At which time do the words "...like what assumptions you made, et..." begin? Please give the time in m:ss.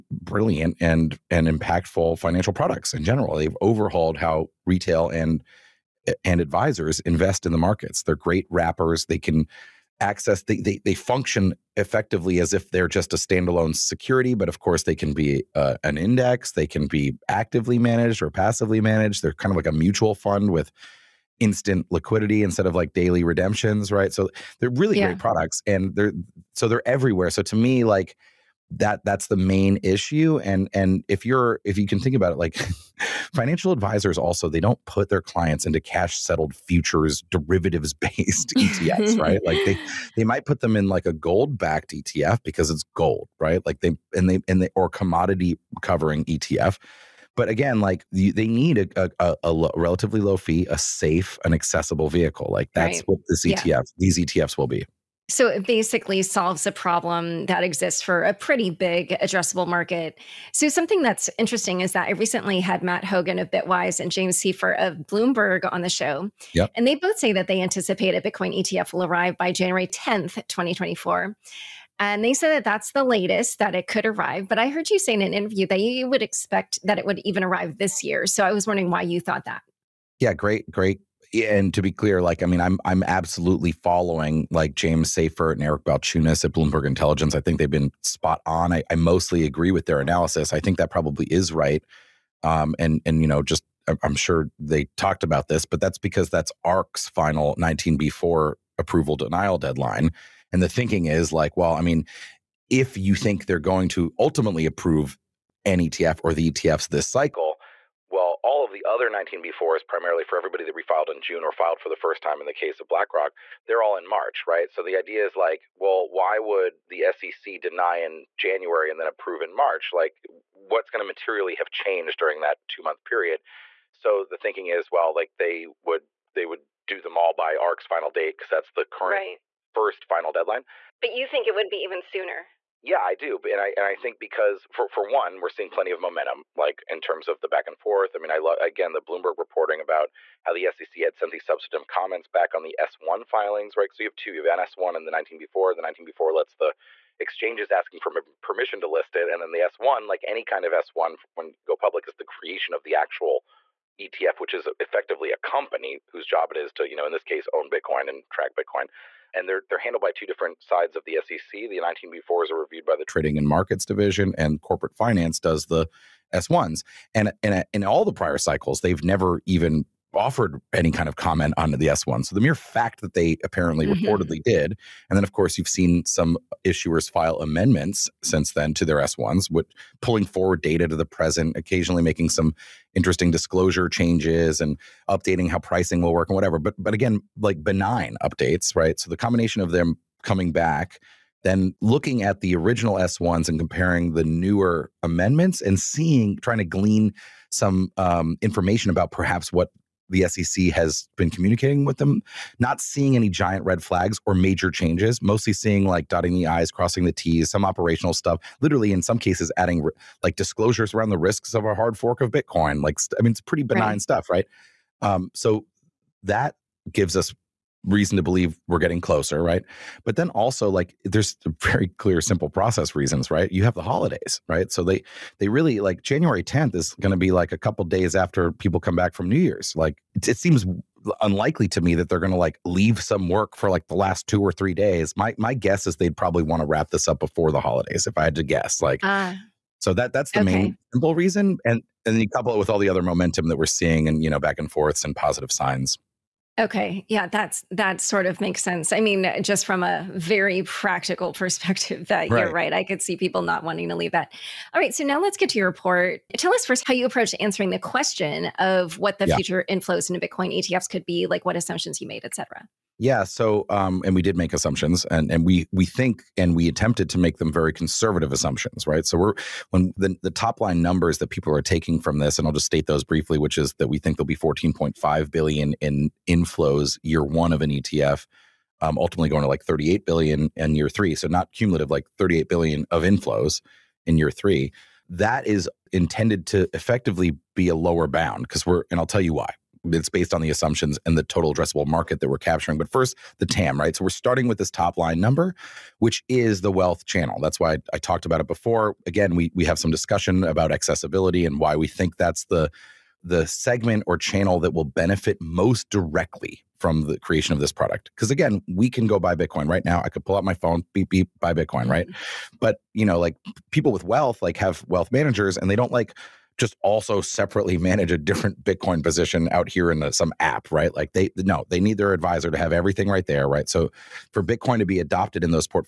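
4:21.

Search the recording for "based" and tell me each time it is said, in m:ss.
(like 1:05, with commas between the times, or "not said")
0:37, 4:50.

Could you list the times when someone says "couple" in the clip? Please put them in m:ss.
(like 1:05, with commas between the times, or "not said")
3:47, 4:02.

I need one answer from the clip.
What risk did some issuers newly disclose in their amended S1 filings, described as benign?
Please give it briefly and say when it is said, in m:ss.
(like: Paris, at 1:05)
a hard fork of Bitcoin, at 3:31.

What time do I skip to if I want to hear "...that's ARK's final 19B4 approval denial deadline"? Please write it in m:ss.
1:36.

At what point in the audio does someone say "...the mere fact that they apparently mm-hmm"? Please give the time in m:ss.
2:52.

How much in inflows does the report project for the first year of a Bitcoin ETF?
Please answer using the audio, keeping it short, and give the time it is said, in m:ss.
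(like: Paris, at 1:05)
14.5 billion, at 4:34.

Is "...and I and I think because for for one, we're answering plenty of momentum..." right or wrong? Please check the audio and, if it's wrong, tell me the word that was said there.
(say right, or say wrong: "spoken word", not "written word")
wrong: "seeing", not "answering".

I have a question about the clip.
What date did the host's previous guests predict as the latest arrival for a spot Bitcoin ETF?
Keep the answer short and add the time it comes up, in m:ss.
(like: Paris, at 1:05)
January 10th, 2024, at 1:09.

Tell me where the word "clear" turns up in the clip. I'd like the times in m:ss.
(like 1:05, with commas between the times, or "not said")
1:21, 3:41.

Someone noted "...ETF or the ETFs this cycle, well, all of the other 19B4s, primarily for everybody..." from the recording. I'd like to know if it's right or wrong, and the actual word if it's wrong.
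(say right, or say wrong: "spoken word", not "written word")
right.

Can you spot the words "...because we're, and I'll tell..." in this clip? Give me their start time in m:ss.
4:48.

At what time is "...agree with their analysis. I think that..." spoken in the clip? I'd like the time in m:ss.
1:29.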